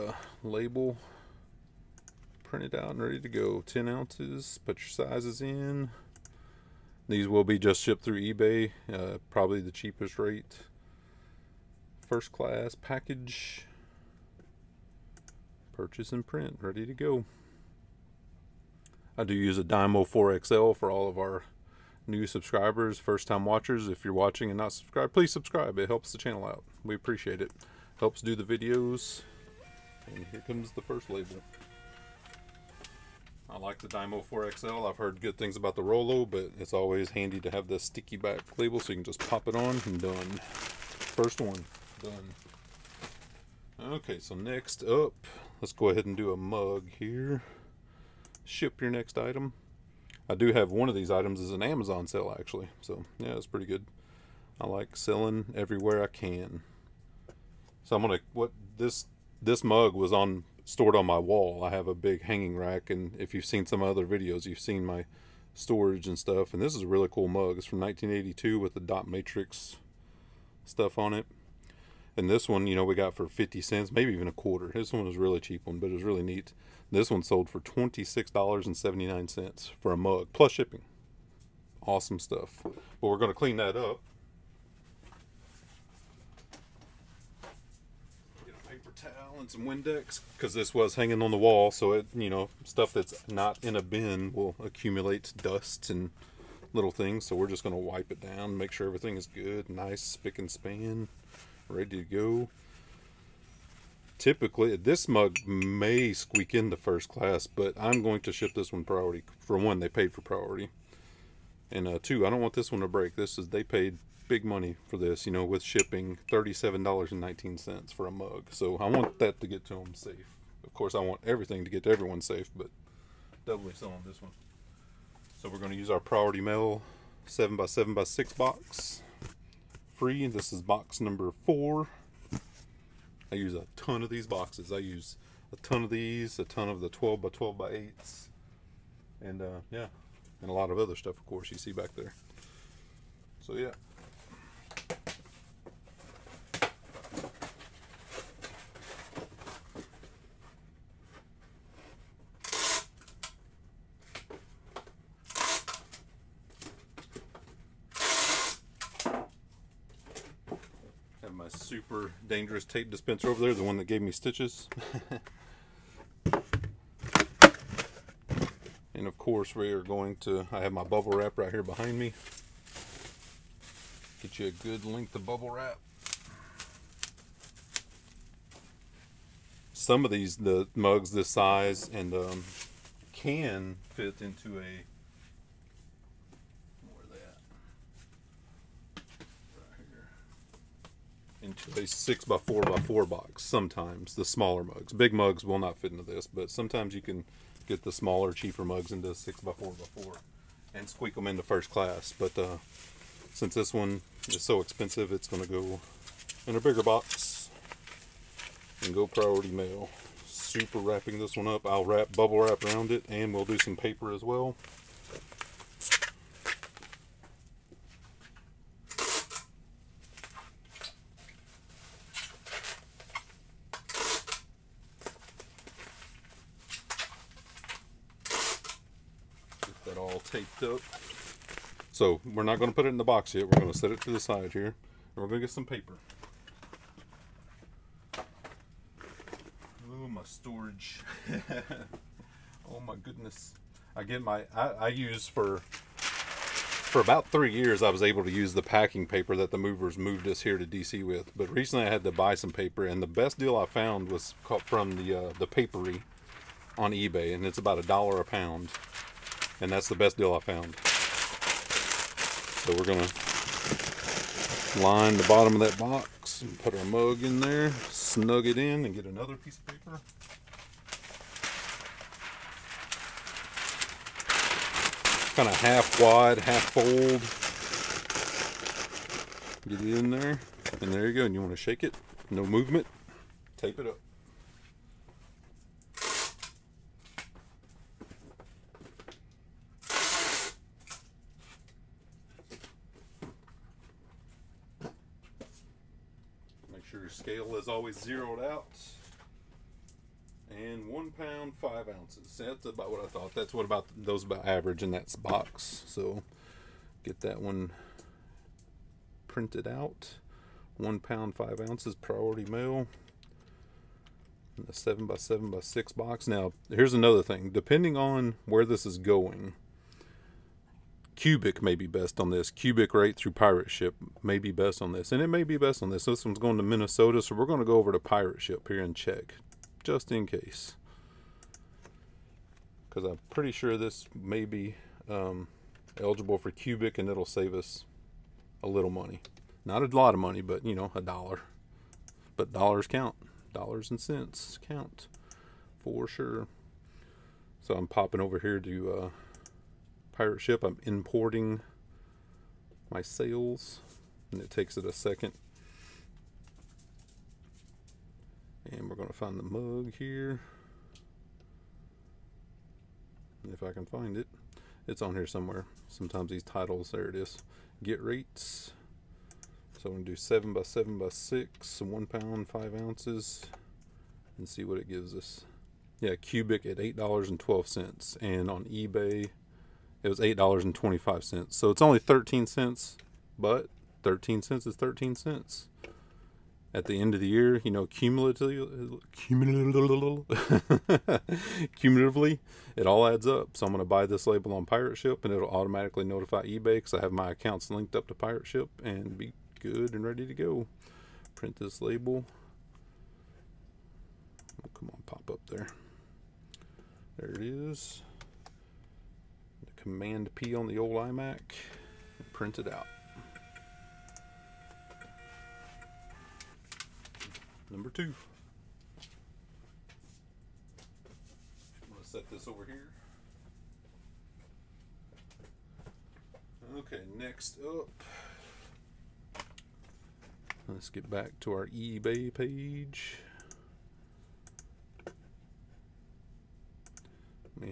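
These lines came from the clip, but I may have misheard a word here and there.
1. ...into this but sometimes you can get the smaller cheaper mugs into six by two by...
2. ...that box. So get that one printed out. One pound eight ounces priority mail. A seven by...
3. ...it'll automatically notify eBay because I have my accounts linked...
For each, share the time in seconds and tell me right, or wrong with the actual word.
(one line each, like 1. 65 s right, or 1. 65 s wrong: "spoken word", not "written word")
1. 195 s wrong: "four", not "two"
2. 304 s wrong: "five", not "eight"
3. 395 s right.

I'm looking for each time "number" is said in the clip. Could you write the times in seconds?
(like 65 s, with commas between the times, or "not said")
130 s, 417 s.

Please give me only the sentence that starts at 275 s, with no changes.
Kind of half wide, half fold.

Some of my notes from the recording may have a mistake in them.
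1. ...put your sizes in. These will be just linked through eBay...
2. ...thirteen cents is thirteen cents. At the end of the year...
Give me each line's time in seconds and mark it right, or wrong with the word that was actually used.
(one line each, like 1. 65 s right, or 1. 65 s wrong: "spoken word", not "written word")
1. 4 s wrong: "shipped", not "linked"
2. 384 s right.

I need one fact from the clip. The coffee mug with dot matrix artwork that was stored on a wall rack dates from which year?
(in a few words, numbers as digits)
1982.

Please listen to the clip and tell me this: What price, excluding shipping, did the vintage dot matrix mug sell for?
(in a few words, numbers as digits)
$26.79.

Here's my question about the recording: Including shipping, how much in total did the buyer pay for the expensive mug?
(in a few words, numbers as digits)
$37.19.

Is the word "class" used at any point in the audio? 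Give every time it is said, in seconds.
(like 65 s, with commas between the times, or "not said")
12 s, 107 s, 201 s.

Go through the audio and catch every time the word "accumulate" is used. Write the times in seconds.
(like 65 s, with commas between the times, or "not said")
94 s.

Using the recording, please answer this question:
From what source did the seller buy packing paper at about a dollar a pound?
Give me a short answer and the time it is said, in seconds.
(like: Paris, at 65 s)
the papery on eBay, at 255 s.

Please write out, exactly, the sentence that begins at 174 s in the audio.
Get you a good length of bubble wrap.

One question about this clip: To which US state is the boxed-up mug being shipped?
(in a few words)
Minnesota.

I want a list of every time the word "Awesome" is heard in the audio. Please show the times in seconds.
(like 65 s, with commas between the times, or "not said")
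81 s.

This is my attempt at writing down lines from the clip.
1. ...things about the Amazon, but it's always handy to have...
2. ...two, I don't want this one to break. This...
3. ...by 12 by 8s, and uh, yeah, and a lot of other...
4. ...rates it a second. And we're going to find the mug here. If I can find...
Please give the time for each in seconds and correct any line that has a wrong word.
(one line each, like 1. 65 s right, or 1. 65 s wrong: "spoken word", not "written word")
1. 35 s wrong: "Rollo", not "Amazon"
2. 112 s right
3. 137 s right
4. 354 s wrong: "takes", not "rates".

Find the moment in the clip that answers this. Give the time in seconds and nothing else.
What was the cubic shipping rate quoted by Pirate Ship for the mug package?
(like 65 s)
376 s.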